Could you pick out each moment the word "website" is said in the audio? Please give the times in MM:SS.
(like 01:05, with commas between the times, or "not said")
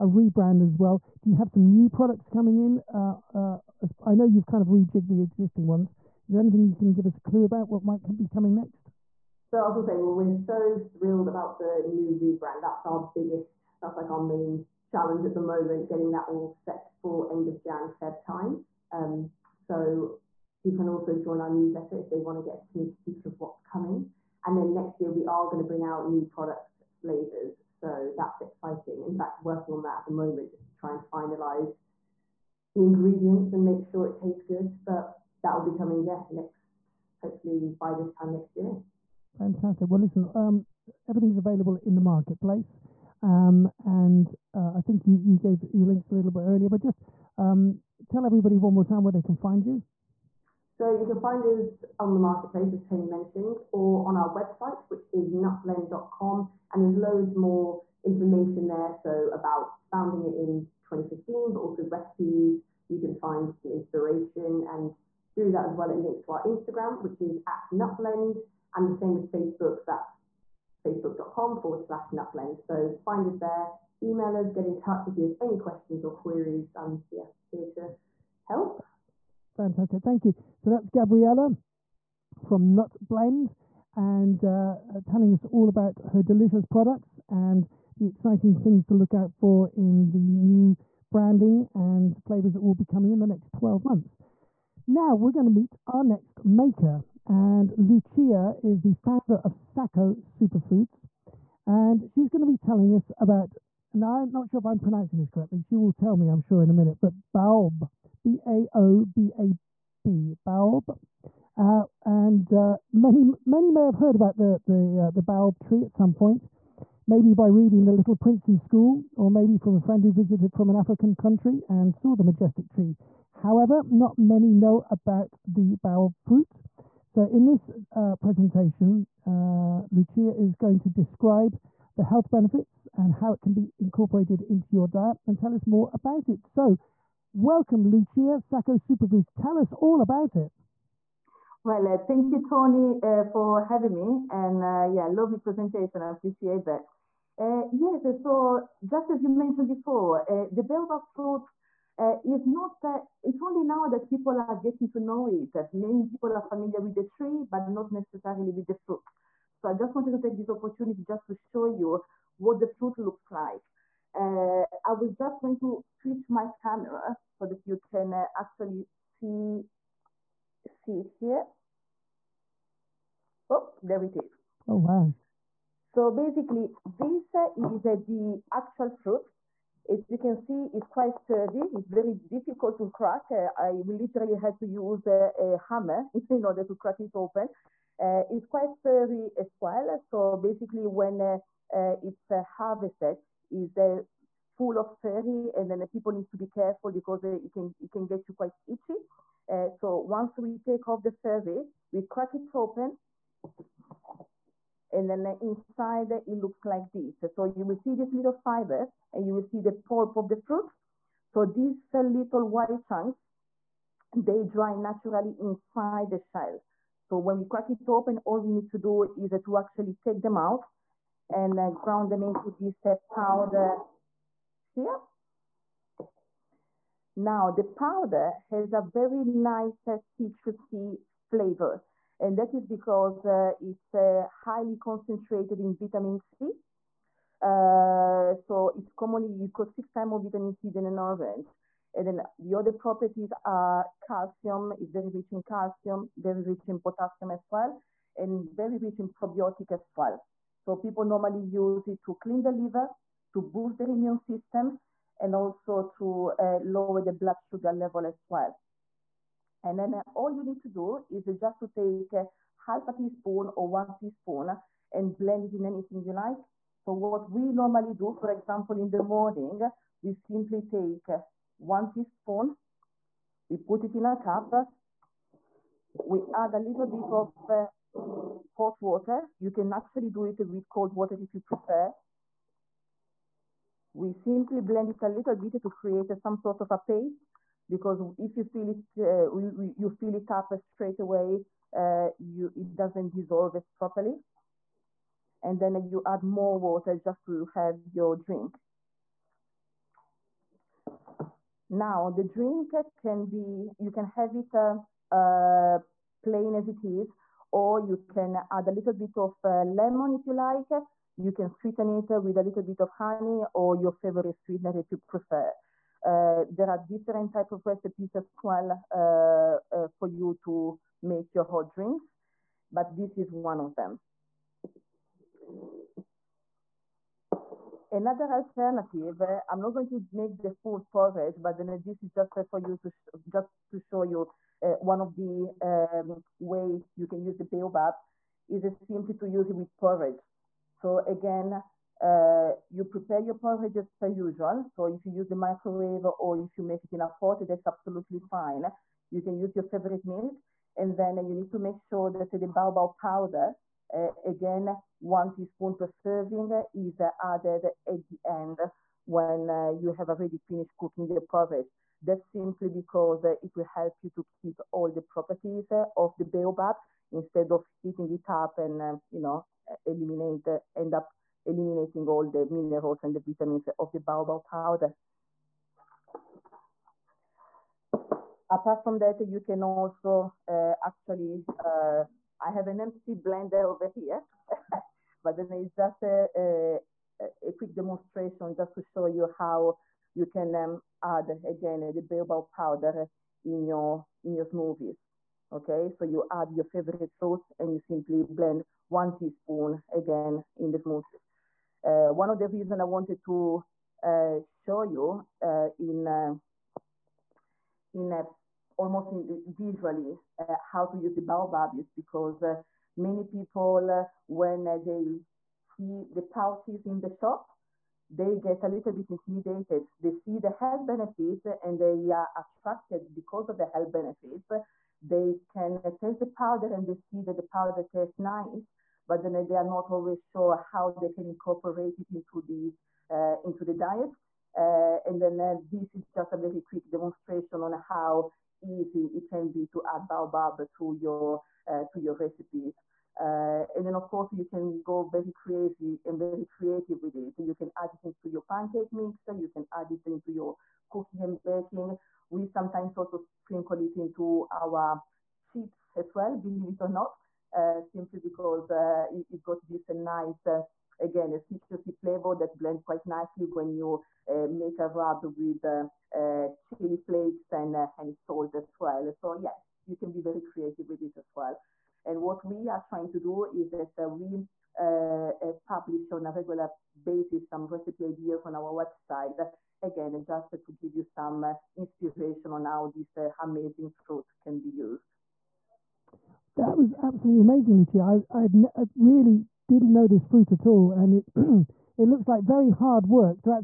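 00:54, 07:58.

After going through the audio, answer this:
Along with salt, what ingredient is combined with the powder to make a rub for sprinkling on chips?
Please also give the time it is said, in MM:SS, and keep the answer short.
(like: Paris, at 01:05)
chili flakes, at 07:46.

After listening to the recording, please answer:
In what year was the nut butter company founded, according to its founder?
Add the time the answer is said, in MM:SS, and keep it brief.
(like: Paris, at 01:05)
2015, at 01:00.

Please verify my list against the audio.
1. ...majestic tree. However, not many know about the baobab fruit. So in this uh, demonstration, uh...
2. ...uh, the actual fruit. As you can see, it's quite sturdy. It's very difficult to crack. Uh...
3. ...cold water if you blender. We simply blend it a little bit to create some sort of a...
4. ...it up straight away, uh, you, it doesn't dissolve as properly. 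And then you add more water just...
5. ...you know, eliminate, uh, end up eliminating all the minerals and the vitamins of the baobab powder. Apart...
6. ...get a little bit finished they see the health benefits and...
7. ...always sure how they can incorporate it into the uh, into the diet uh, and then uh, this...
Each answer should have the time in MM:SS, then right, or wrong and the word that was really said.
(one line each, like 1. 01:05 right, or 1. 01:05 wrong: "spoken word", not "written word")
1. 02:02 wrong: "presentation", not "demonstration"
2. 02:57 right
3. 04:40 wrong: "prefer", not "blender"
4. 04:50 right
5. 06:09 right
6. 06:58 wrong: "intimidated", not "finished"
7. 07:09 right.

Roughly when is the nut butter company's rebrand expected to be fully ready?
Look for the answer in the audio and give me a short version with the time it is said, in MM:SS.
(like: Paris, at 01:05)
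end of Jan, Feb, at 00:17.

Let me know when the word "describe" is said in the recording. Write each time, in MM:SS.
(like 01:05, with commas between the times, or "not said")
02:10.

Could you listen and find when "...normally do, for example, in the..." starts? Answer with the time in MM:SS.
04:27.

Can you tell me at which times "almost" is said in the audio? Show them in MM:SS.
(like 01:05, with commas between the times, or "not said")
06:48.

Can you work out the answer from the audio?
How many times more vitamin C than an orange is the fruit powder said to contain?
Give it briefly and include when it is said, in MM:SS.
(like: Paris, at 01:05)
6, at 03:59.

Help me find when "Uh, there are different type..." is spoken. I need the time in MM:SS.
05:16.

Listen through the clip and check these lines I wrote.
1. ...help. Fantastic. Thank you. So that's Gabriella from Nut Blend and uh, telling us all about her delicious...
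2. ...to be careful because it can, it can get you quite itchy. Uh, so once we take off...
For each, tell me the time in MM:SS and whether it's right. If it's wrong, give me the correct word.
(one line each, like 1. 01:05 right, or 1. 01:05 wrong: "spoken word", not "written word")
1. 01:18 right
2. 03:16 right.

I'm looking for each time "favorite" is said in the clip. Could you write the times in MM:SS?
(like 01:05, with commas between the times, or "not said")
05:13, 05:49, 06:36.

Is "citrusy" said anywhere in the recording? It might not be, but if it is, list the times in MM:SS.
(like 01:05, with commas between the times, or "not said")
03:49, 07:41.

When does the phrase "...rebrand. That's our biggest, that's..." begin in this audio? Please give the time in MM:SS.
00:12.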